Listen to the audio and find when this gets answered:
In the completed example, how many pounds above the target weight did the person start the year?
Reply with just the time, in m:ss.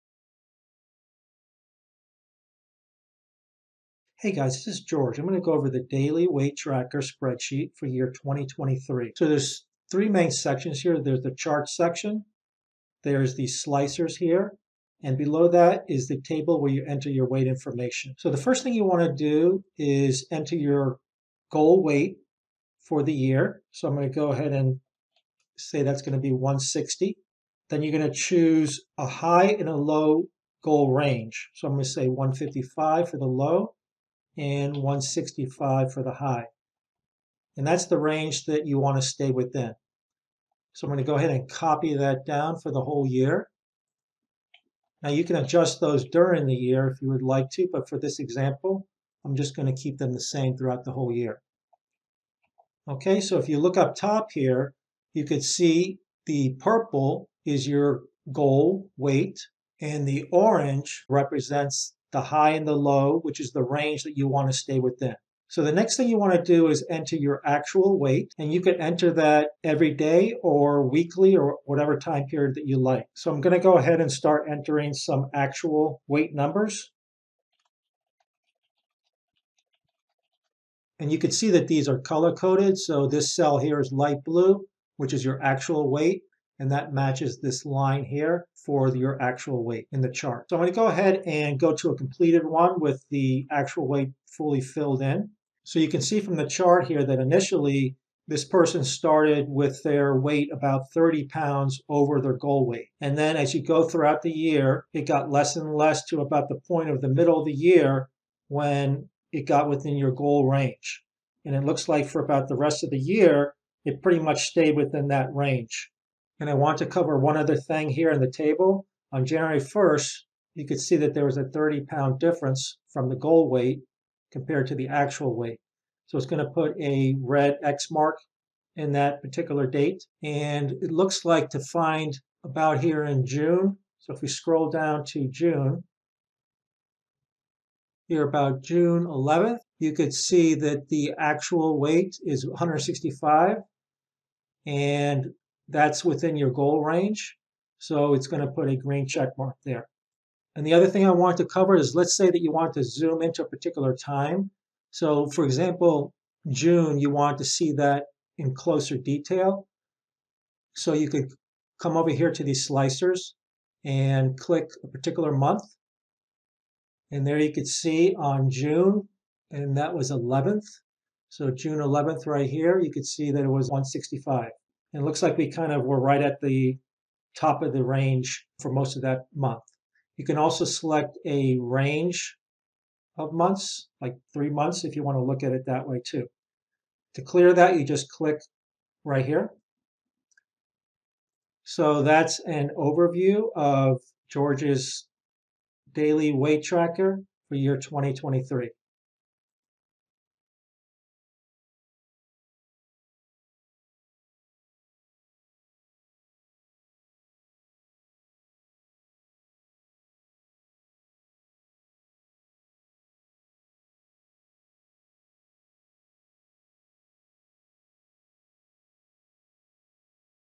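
1:40.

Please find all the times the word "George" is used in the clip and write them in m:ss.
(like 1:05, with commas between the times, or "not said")
0:04, 3:14.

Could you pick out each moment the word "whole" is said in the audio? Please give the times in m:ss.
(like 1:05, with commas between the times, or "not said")
0:42, 0:50.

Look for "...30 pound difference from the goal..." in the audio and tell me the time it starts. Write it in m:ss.
2:01.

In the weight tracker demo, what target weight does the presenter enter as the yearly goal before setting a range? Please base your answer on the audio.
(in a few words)
160.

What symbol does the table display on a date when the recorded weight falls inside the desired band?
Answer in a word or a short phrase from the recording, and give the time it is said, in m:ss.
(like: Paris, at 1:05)
green check mark, at 2:28.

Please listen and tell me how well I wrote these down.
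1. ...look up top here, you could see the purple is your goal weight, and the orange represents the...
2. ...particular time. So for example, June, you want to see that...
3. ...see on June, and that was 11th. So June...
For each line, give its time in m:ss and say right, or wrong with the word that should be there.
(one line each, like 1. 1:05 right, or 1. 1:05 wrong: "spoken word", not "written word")
1. 0:53 right
2. 2:33 right
3. 2:47 right.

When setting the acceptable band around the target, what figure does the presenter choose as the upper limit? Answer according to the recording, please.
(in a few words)
165.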